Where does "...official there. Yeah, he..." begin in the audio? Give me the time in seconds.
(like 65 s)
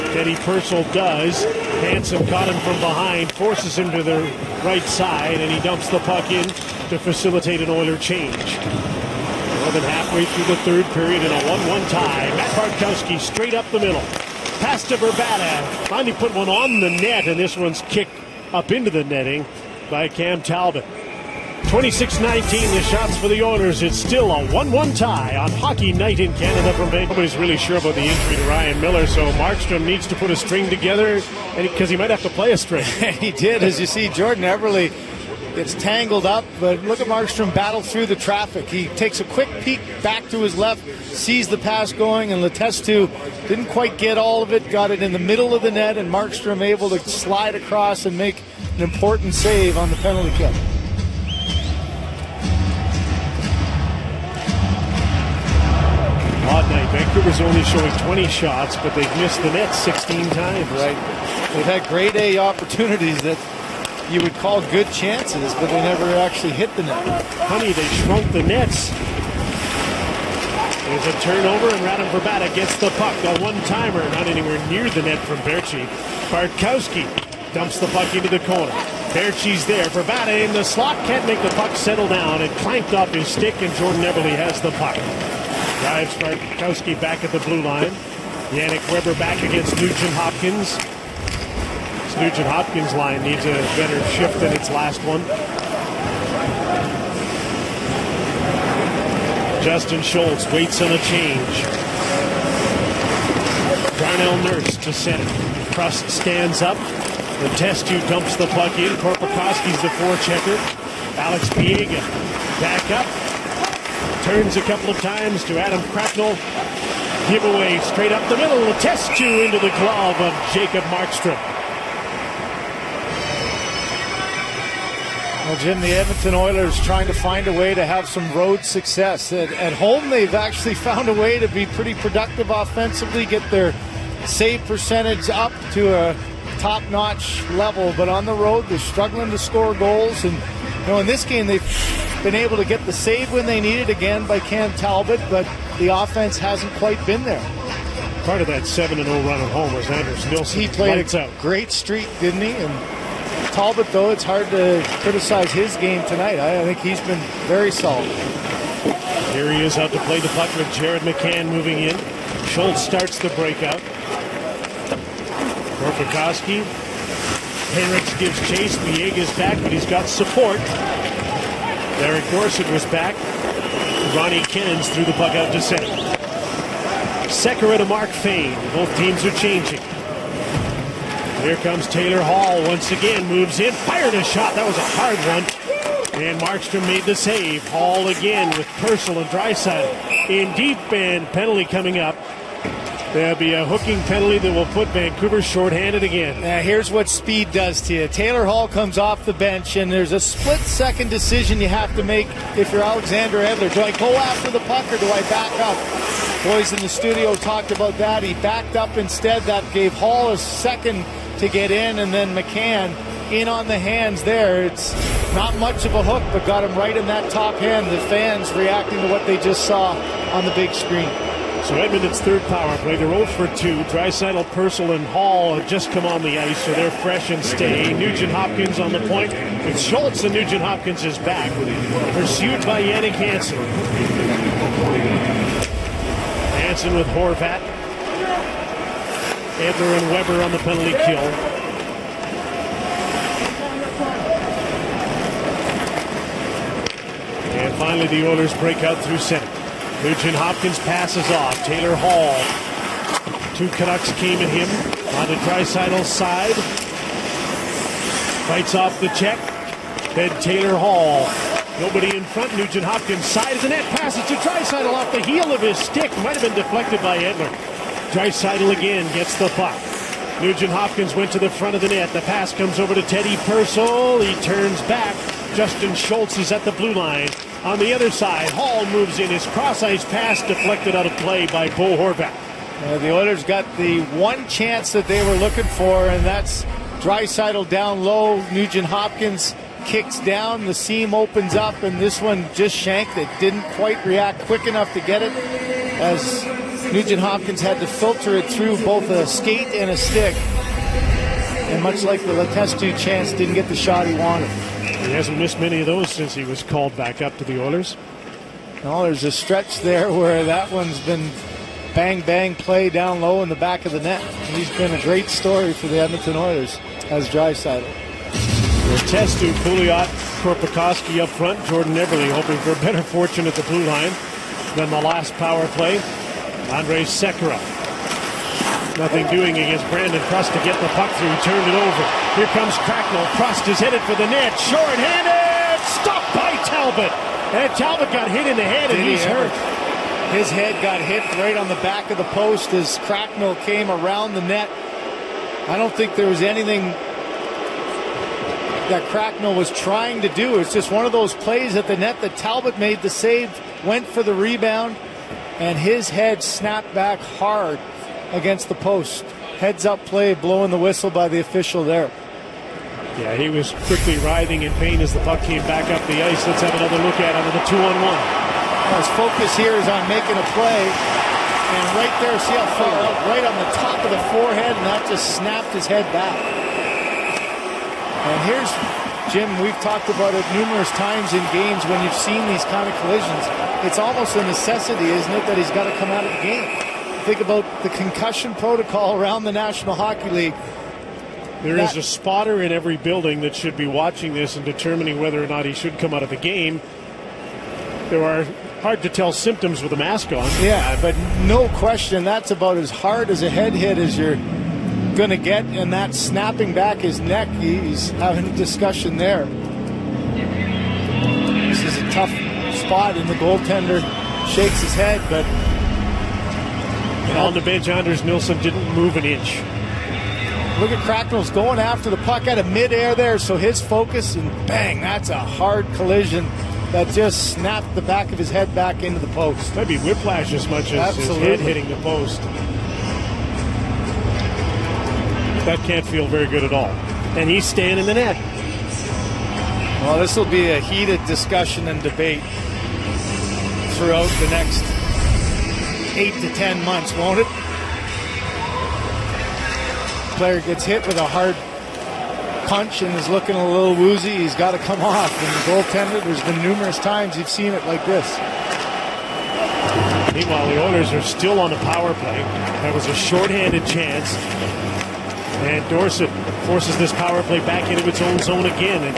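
361 s.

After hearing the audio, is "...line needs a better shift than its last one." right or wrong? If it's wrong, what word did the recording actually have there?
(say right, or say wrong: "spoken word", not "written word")
right.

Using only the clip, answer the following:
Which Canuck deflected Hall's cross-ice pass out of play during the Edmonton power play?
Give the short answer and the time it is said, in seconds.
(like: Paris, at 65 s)
Bo Horvat, at 281 s.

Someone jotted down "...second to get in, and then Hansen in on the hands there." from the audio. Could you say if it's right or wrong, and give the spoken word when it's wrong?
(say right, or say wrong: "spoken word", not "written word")
wrong: "McCann", not "Hansen".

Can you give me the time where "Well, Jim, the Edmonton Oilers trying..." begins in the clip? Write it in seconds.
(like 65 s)
125 s.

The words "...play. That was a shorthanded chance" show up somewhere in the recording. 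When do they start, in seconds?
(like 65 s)
462 s.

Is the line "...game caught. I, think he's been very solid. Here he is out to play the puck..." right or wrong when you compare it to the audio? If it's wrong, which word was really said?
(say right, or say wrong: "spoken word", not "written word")
wrong: "tonight", not "caught".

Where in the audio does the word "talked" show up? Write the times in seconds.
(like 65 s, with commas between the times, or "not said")
207 s, 379 s.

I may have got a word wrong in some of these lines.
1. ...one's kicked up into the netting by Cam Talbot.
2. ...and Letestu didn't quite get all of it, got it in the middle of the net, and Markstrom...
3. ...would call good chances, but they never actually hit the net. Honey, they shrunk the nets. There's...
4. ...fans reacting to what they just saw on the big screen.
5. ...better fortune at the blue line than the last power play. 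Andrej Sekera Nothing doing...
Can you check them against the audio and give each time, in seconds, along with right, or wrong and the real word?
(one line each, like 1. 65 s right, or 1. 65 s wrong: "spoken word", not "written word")
1. 17 s right
2. 42 s right
3. 64 s right
4. 218 s right
5. 322 s right.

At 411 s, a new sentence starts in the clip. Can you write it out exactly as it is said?
This is a tough spot, and the goaltender shakes his head, but and on the bench, Anders Nilsson didn't move an inch.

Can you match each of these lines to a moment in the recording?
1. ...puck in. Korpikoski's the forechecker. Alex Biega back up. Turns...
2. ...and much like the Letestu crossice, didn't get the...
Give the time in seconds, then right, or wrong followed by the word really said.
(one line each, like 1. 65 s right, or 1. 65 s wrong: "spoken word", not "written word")
1. 108 s right
2. 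301 s wrong: "chance", not "crossice".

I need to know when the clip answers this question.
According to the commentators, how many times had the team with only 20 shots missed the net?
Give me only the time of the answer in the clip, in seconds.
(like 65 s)
59 s.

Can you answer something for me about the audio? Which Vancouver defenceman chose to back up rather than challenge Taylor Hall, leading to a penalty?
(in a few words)
Alexander Edler.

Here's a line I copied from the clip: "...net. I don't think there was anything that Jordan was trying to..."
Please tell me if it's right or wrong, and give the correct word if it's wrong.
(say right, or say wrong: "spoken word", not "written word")
wrong: "Cracknell", not "Jordan".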